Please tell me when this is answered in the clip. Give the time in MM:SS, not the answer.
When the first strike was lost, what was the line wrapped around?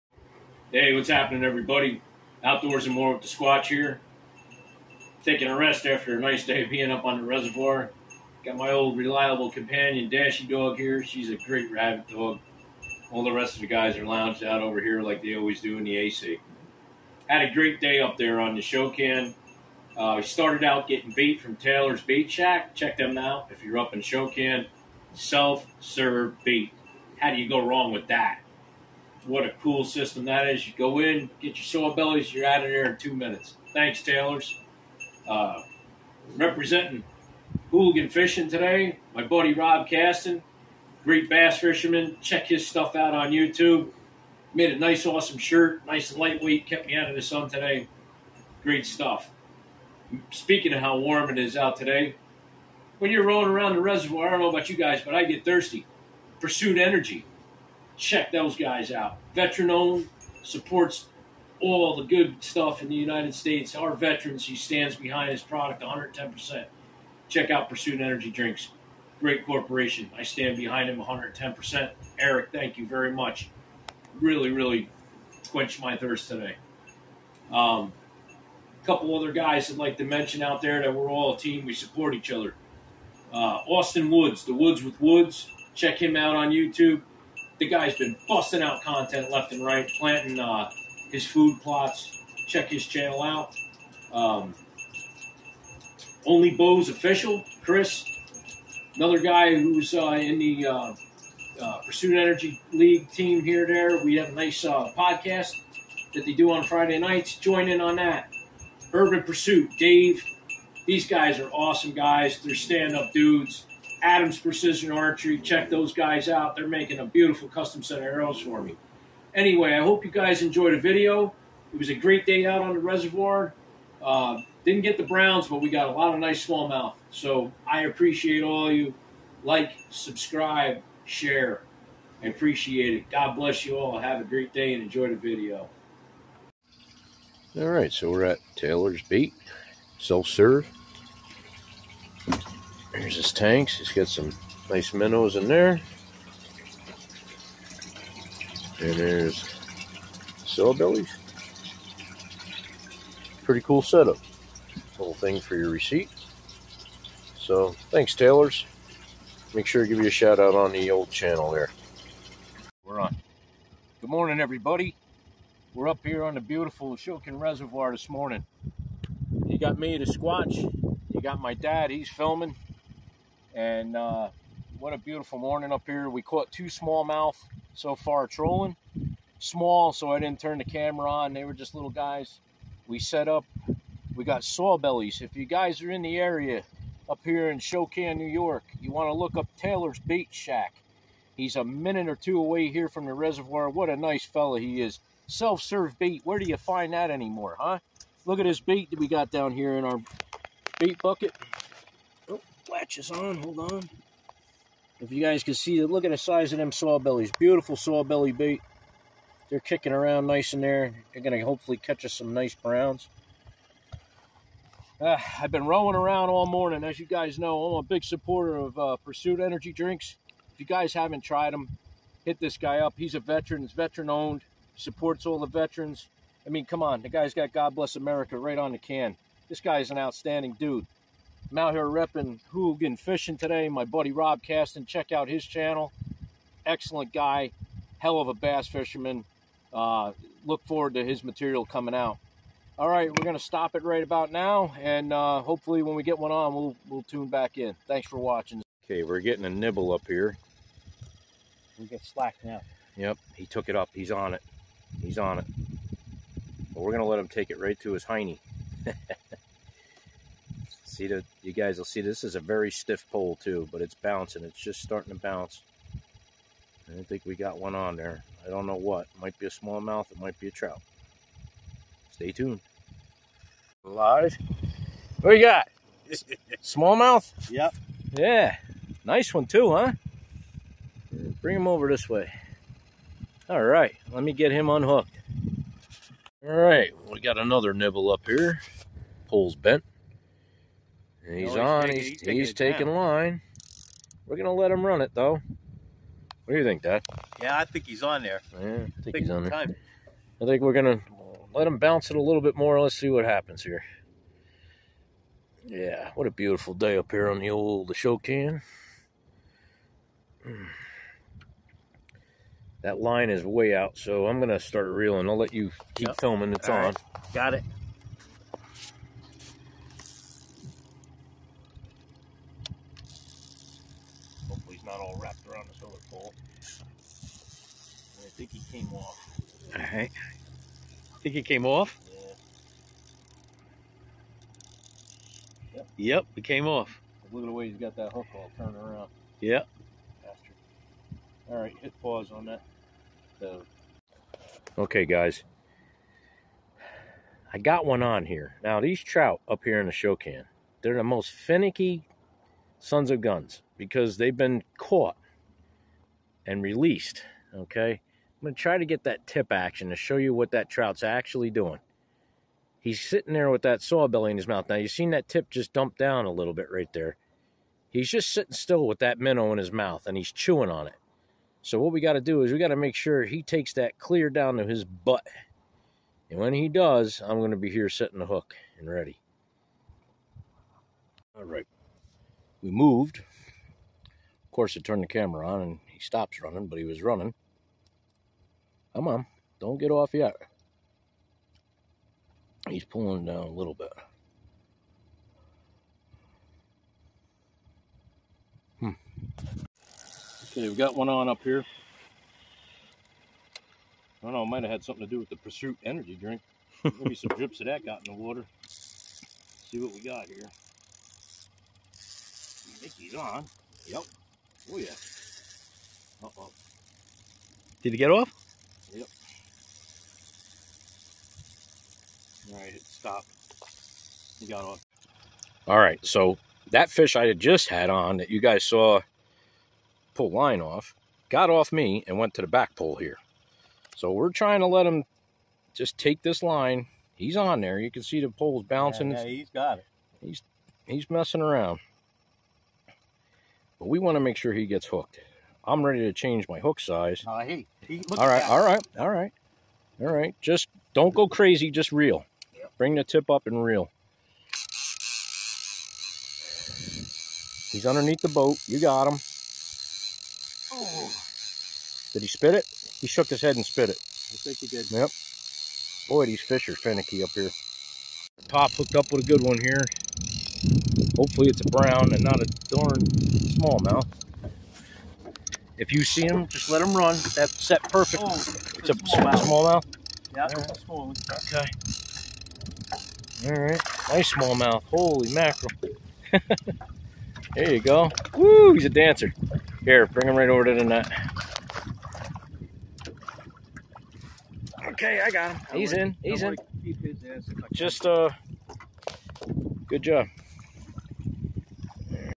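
05:25.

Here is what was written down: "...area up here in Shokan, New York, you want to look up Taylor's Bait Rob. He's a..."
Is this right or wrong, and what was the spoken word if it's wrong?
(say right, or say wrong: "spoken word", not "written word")
wrong: "Shack", not "Rob".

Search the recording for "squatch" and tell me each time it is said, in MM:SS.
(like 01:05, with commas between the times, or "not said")
00:03, 02:50.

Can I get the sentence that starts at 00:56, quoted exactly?
Pursuit Energy, check those guys out.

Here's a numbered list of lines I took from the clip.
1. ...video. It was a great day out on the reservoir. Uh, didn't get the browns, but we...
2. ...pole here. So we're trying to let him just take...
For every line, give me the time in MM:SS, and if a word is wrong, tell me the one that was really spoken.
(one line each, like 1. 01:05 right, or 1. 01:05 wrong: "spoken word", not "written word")
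1. 02:00 right
2. 07:12 right.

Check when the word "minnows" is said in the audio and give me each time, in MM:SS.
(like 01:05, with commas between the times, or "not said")
02:24, 06:09.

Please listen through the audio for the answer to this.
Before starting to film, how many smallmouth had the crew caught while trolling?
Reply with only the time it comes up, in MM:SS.
02:56.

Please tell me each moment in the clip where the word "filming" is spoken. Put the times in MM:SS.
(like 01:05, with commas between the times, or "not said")
02:52, 05:16.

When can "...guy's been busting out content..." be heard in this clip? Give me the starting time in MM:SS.
01:27.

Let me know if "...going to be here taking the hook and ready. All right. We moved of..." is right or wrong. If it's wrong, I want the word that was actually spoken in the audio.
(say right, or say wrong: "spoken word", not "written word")
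wrong: "setting", not "taking".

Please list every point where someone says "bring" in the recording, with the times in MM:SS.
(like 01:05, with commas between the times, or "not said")
04:41, 07:32, 08:10.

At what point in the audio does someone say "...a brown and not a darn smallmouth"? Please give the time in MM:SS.
07:51.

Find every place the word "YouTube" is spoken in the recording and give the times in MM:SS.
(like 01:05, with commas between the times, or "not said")
00:43, 01:26.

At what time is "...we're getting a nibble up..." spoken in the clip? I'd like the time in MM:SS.
04:09.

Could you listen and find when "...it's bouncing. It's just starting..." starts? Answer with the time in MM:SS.
04:23.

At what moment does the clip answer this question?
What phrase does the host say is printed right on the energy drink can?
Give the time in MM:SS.
03:47.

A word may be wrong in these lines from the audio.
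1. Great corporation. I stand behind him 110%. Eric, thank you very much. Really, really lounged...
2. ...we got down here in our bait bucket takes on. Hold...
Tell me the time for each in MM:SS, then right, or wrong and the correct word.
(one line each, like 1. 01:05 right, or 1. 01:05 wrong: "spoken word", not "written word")
1. 01:09 wrong: "quenched", not "lounged"
2. 03:18 wrong: "latches", not "takes".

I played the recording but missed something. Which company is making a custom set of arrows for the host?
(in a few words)
Adams Precision Archery.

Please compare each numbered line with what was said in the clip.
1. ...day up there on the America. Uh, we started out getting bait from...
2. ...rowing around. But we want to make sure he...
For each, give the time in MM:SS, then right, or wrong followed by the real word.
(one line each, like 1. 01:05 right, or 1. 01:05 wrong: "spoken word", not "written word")
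1. 00:17 wrong: "Shokan", not "America"
2. 07:21 wrong: "messing", not "rowing".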